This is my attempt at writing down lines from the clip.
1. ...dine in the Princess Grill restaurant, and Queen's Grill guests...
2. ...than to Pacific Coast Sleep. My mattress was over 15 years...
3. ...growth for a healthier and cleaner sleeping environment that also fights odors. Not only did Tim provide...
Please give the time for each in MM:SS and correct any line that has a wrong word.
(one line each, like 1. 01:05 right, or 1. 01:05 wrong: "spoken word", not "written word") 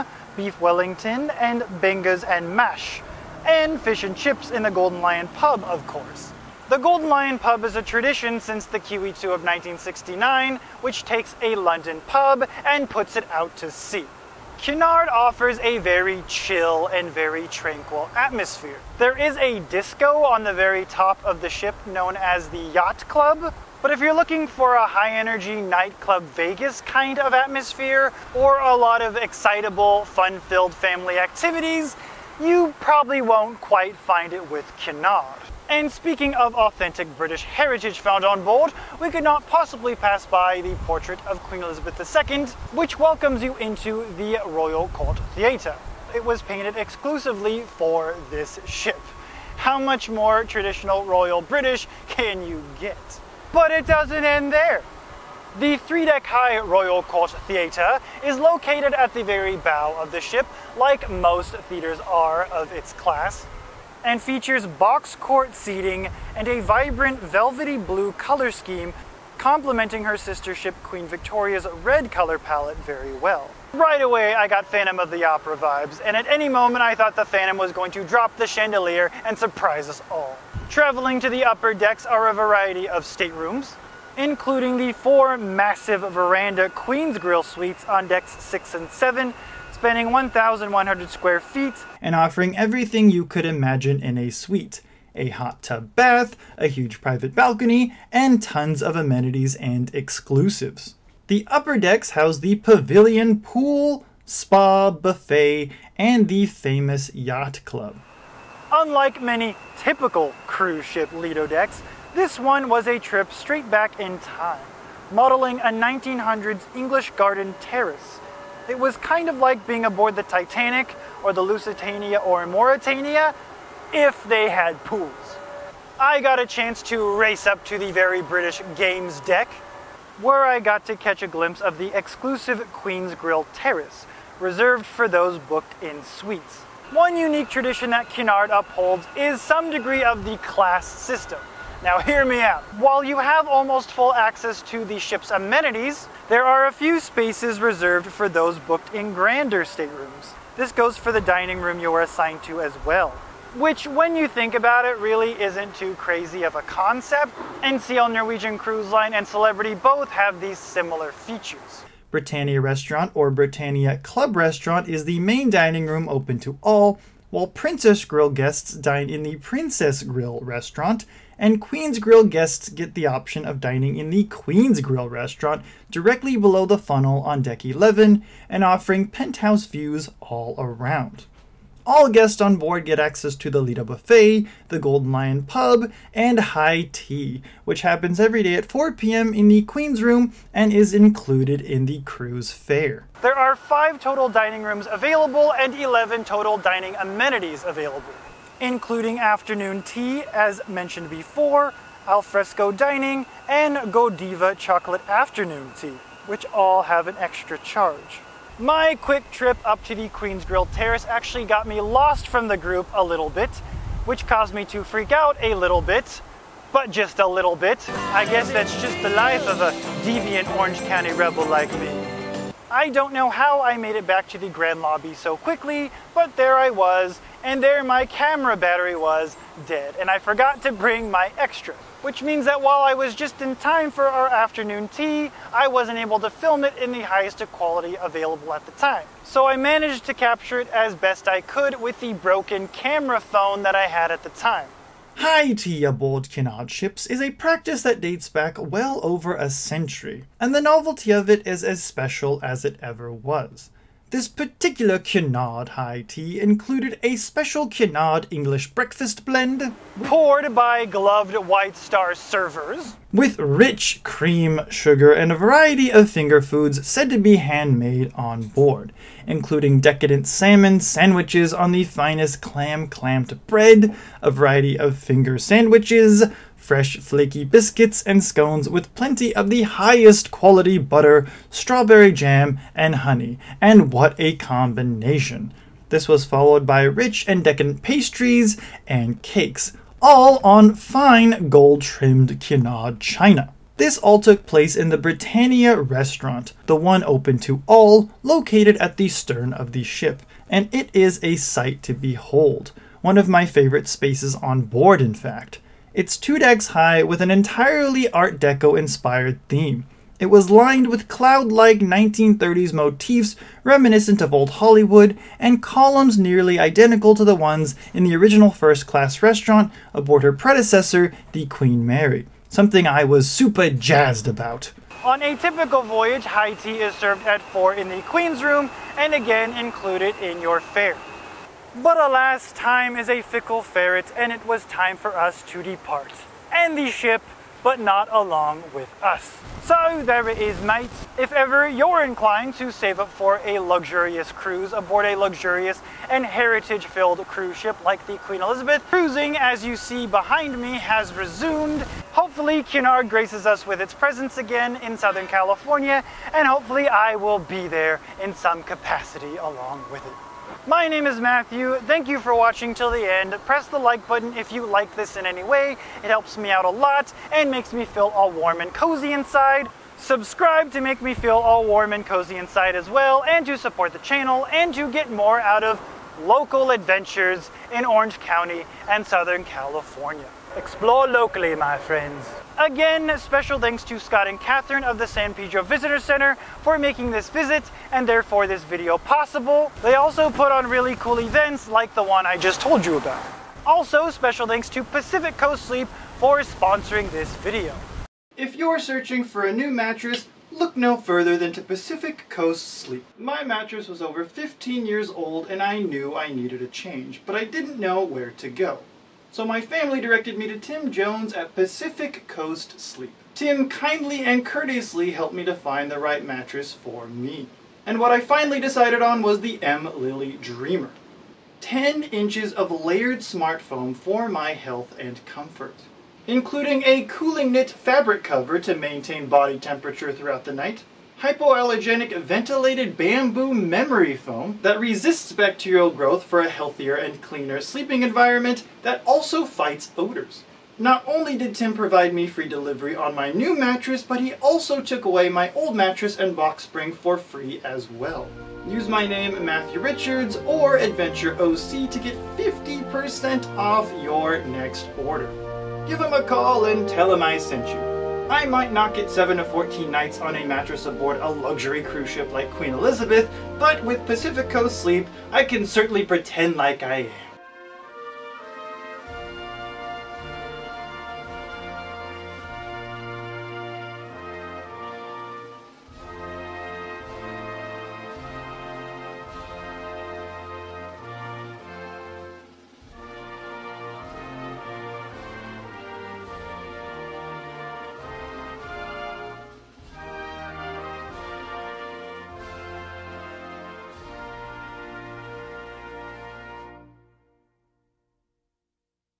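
1. 02:48 right
2. 06:41 right
3. 07:15 right.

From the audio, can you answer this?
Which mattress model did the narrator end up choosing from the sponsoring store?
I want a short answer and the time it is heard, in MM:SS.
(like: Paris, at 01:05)
M. Lily Dreamer, at 06:59.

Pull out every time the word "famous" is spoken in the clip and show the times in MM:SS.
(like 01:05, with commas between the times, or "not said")
01:46.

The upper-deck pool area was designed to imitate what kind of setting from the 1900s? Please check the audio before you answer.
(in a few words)
English garden terrace.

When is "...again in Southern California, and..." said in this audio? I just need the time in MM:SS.
05:54.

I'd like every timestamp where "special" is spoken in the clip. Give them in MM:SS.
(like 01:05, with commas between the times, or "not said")
04:11, 04:17, 06:23, 06:34.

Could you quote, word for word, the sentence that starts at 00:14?
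Cunard offers a very chill and very tranquil atmosphere.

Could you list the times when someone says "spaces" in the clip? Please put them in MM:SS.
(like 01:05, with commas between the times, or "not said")
02:26, 05:03.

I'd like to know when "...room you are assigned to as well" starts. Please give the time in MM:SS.
02:31.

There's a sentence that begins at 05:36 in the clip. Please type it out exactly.
And the ship, but not along with us.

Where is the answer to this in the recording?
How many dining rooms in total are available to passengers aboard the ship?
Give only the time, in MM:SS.
03:13.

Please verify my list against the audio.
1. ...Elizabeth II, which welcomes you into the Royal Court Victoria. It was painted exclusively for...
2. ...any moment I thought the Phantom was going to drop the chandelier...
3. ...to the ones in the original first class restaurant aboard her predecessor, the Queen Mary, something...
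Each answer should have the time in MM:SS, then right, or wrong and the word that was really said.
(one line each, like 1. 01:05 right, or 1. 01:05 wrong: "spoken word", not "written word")
1. 00:41 wrong: "Theatre", not "Victoria"
2. 01:16 right
3. 05:17 right.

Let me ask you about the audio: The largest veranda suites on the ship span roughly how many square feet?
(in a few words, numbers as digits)
1,100.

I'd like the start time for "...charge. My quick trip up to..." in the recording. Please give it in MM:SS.
03:27.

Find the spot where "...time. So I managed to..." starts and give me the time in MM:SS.
03:58.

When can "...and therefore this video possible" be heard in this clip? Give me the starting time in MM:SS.
06:27.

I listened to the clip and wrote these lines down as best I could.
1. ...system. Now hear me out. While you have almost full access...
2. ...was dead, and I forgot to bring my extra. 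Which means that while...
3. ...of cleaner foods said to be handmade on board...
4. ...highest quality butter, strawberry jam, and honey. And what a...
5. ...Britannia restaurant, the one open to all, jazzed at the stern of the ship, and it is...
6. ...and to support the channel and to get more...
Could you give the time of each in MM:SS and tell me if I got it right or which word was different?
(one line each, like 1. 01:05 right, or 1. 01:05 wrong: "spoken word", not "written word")
1. 02:20 right
2. 03:48 right
3. 04:25 wrong: "finger", not "cleaner"
4. 04:39 right
5. 04:55 wrong: "located", not "jazzed"
6. 06:13 right.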